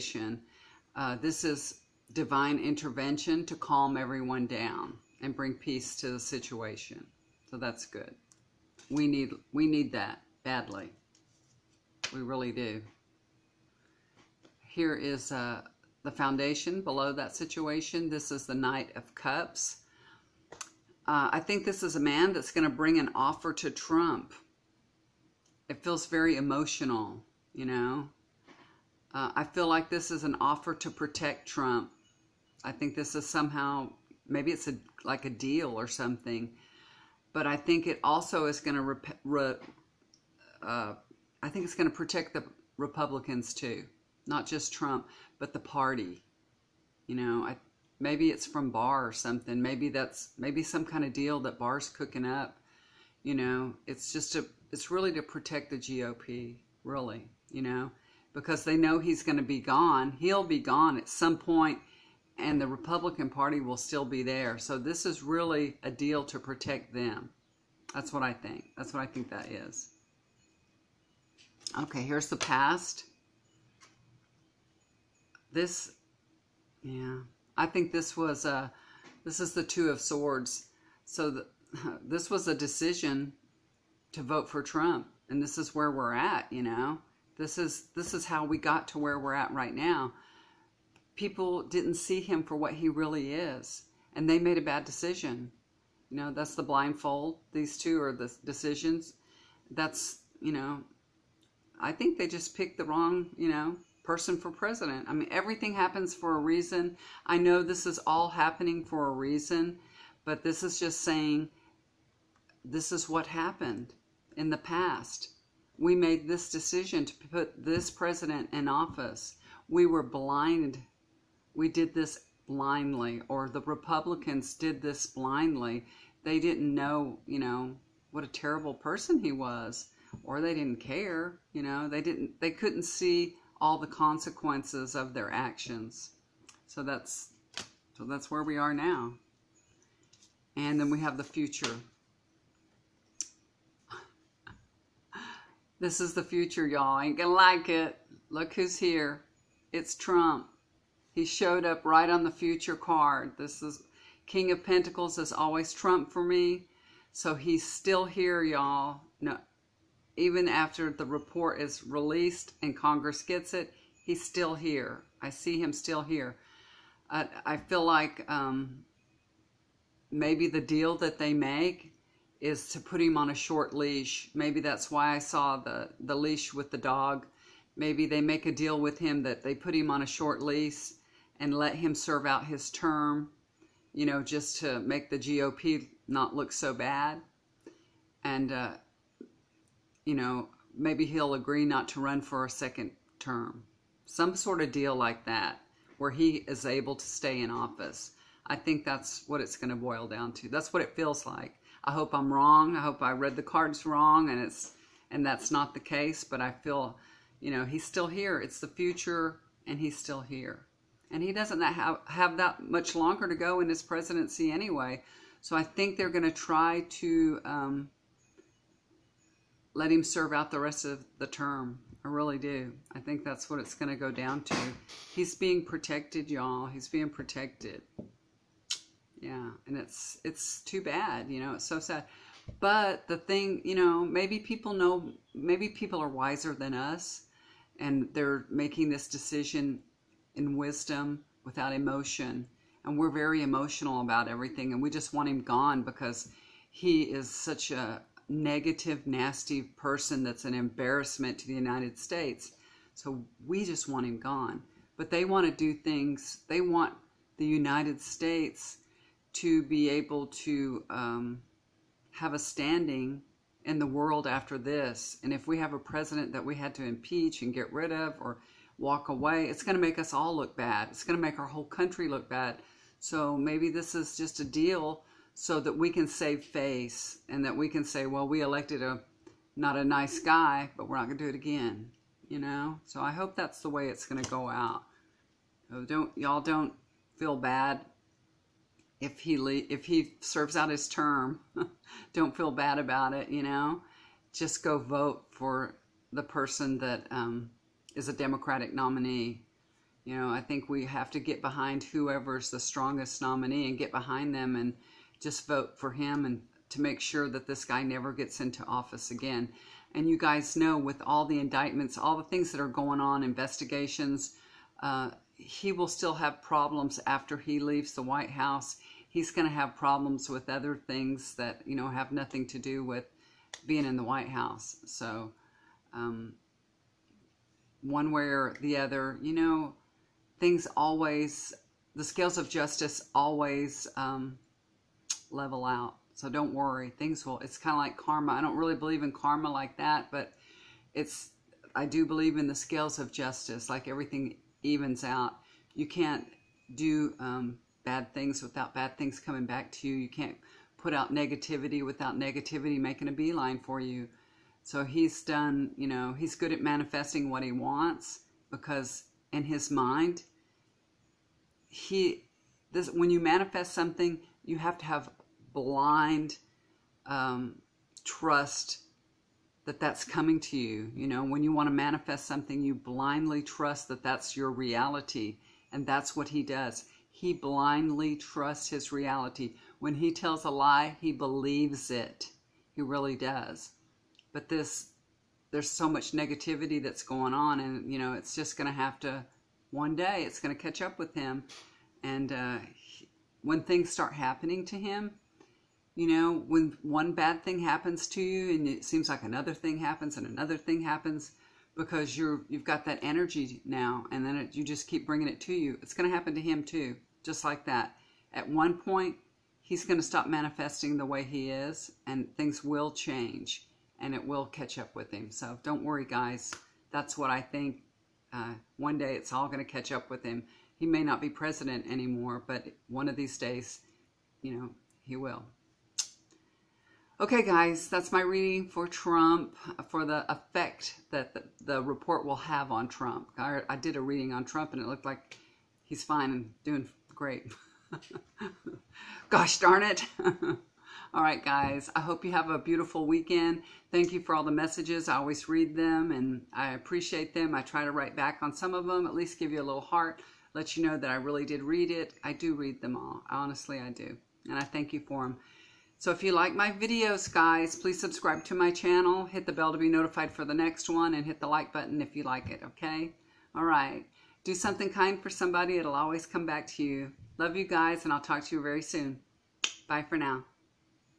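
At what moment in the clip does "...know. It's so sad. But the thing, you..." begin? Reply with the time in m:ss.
3:51.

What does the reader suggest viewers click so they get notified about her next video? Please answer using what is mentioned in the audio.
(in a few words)
the bell.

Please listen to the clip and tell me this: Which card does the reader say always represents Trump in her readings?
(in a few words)
King of Pentacles.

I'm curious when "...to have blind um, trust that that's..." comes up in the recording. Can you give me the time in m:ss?
6:04.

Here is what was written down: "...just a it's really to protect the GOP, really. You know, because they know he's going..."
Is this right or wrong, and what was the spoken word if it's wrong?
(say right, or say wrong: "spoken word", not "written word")
right.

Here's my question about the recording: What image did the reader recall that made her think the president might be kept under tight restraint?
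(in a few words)
leash with the dog.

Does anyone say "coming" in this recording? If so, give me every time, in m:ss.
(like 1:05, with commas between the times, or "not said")
5:49, 6:10.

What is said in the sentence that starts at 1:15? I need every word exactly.
This, yeah, I think this was a, uh, this is the Two of Swords.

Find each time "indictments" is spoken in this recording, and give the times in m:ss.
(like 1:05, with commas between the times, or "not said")
5:11.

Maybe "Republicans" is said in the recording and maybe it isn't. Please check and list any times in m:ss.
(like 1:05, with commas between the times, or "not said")
0:42, 1:02, 2:03.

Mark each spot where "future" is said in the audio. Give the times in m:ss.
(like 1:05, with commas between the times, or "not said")
2:21, 2:26, 2:32, 3:28.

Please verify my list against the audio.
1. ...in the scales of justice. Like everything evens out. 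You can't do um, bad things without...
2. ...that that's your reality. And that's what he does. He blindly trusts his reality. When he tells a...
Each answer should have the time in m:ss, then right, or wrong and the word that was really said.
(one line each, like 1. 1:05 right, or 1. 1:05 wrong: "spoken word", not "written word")
1. 5:42 right
2. 6:13 right.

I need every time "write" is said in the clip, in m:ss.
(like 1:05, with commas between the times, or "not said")
7:27.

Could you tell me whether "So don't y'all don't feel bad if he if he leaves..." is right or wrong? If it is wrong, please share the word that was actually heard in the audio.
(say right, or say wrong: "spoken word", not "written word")
wrong: "serves", not "leaves".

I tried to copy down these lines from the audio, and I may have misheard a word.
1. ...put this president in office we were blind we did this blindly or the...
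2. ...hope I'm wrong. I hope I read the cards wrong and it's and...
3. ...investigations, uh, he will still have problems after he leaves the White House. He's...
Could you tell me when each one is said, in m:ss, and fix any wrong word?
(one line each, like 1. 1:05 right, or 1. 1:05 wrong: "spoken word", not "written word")
1. 1:57 right
2. 3:21 right
3. 5:13 right.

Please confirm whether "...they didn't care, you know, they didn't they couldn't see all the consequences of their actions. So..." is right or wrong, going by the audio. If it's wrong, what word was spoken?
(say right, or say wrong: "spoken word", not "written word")
right.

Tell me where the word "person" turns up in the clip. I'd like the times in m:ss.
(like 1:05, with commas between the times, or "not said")
1:44, 2:08, 4:09, 4:56.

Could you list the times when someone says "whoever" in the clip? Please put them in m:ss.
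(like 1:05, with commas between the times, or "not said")
5:01.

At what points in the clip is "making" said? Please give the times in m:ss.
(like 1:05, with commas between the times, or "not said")
3:58, 5:52.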